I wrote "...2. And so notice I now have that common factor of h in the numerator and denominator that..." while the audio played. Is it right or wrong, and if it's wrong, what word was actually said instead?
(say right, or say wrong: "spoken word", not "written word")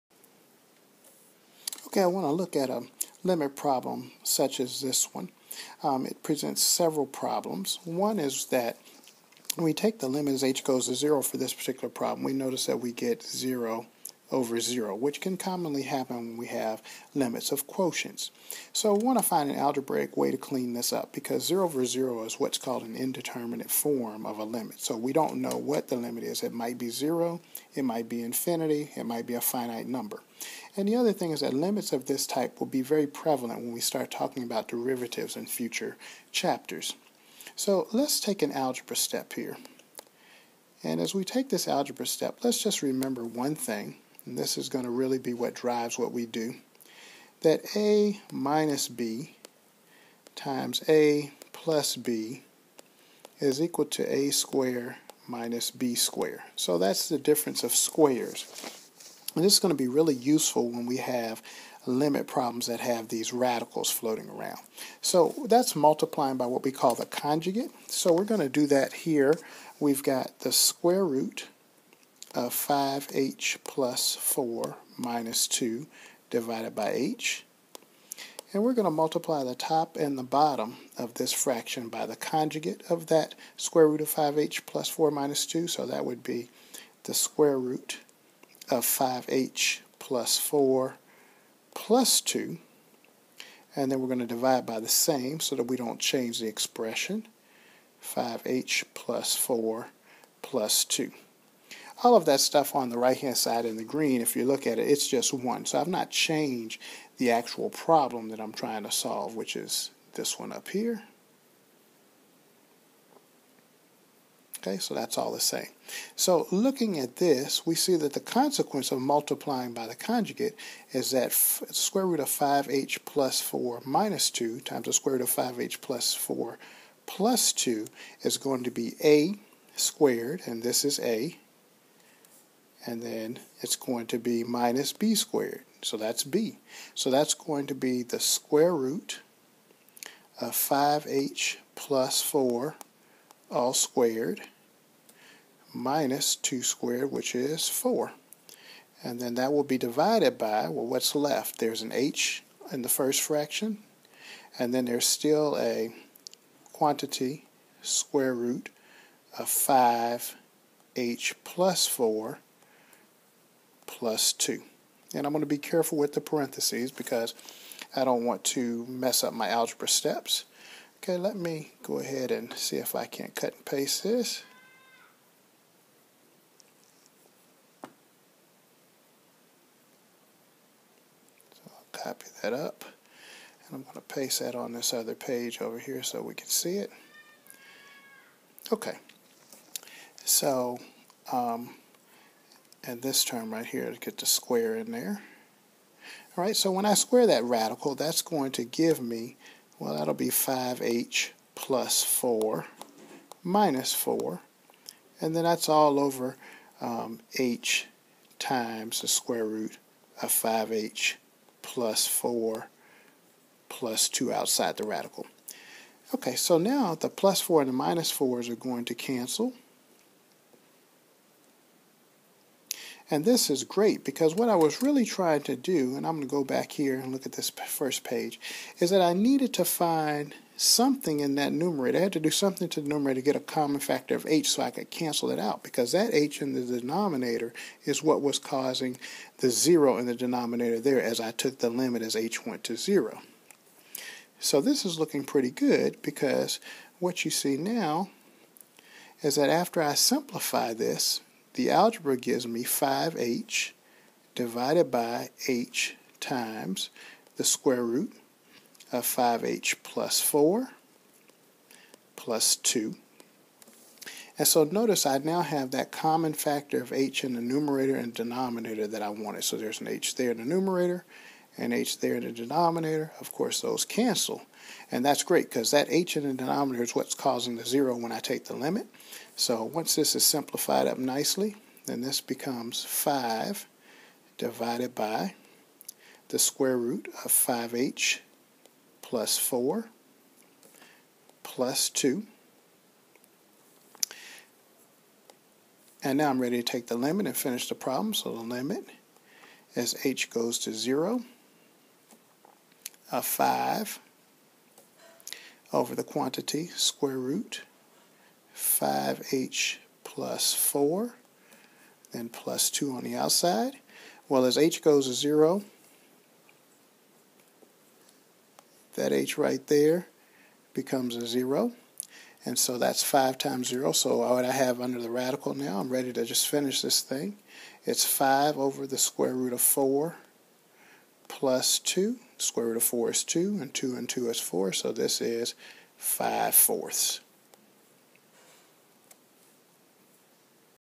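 right.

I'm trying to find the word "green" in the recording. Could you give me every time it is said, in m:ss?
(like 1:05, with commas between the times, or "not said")
1:43.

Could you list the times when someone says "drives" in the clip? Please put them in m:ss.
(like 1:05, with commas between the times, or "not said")
0:45.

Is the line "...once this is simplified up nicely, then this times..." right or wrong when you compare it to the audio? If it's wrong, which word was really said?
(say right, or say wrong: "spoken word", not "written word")
wrong: "becomes", not "times".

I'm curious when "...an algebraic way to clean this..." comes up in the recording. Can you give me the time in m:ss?
0:19.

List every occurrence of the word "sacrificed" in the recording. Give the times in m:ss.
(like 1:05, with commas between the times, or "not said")
not said.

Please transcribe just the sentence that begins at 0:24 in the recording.
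So we don't know what the limit is.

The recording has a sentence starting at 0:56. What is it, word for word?
So that's the difference of squares.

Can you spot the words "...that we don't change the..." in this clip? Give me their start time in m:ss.
1:35.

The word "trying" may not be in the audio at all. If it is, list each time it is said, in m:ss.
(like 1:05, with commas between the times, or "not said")
1:48, 3:45.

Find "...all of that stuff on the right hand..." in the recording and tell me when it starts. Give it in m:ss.
1:42.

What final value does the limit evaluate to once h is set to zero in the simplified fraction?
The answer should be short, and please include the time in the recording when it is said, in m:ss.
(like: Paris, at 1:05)
5/4, at 5:35.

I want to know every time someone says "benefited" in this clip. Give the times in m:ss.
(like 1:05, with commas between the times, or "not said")
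not said.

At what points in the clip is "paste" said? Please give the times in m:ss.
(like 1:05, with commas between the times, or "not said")
2:53, 3:04.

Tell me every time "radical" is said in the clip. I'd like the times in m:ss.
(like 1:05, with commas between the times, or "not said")
1:03, 3:17, 3:34, 5:25.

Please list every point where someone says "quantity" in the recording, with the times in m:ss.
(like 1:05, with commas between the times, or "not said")
2:36, 5:06.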